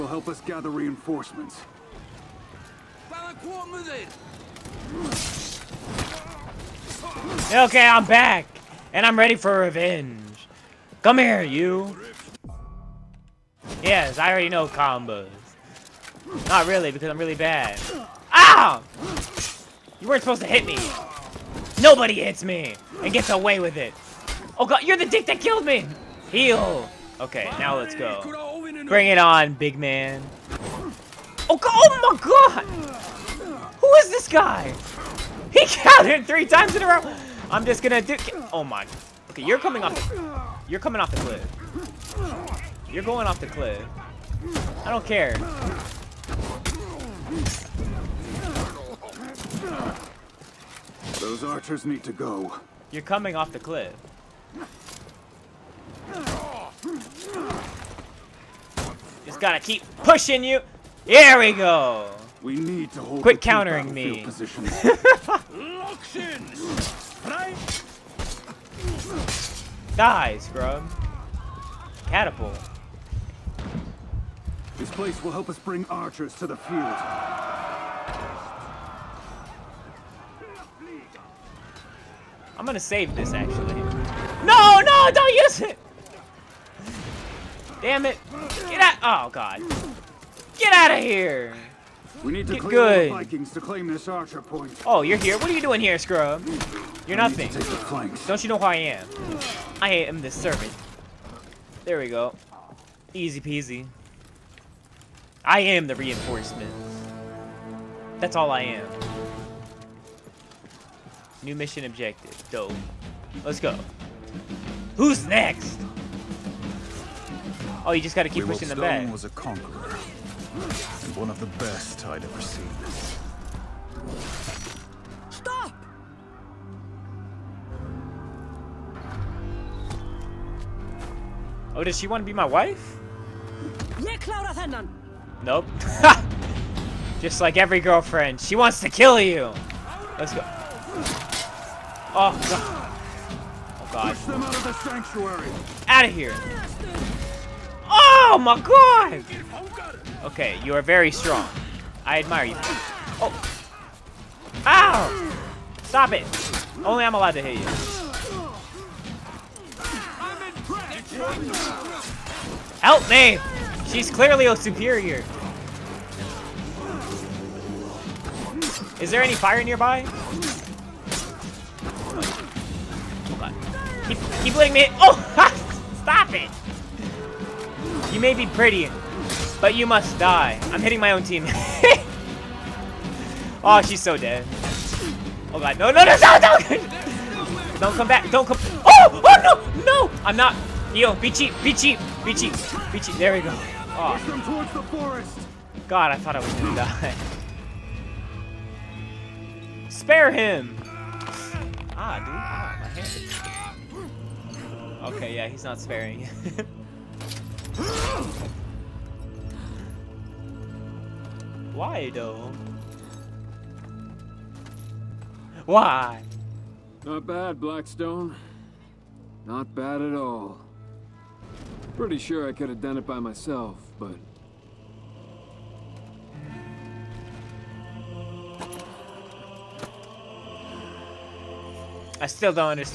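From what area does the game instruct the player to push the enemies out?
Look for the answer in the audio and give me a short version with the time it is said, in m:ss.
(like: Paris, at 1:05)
the sanctuary, at 2:24.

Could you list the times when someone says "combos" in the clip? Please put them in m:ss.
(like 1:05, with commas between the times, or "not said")
0:14.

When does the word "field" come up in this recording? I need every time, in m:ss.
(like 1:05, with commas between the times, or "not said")
1:16.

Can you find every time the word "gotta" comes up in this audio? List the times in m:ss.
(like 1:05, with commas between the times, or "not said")
0:59, 1:58.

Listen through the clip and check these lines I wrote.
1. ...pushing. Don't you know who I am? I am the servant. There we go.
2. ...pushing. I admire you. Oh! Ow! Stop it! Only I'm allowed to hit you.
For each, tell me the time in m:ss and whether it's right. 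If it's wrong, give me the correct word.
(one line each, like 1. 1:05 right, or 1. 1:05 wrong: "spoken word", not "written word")
1. 1:37 wrong: "nothing", not "pushing"
2. 2:31 wrong: "strong", not "pushing".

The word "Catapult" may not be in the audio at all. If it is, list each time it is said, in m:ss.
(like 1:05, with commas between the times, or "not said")
1:12.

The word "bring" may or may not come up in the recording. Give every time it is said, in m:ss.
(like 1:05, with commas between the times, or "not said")
0:28, 1:15.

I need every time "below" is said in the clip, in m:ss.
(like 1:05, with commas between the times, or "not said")
not said.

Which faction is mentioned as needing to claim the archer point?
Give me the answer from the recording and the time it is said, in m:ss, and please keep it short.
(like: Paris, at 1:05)
Vikings, at 1:33.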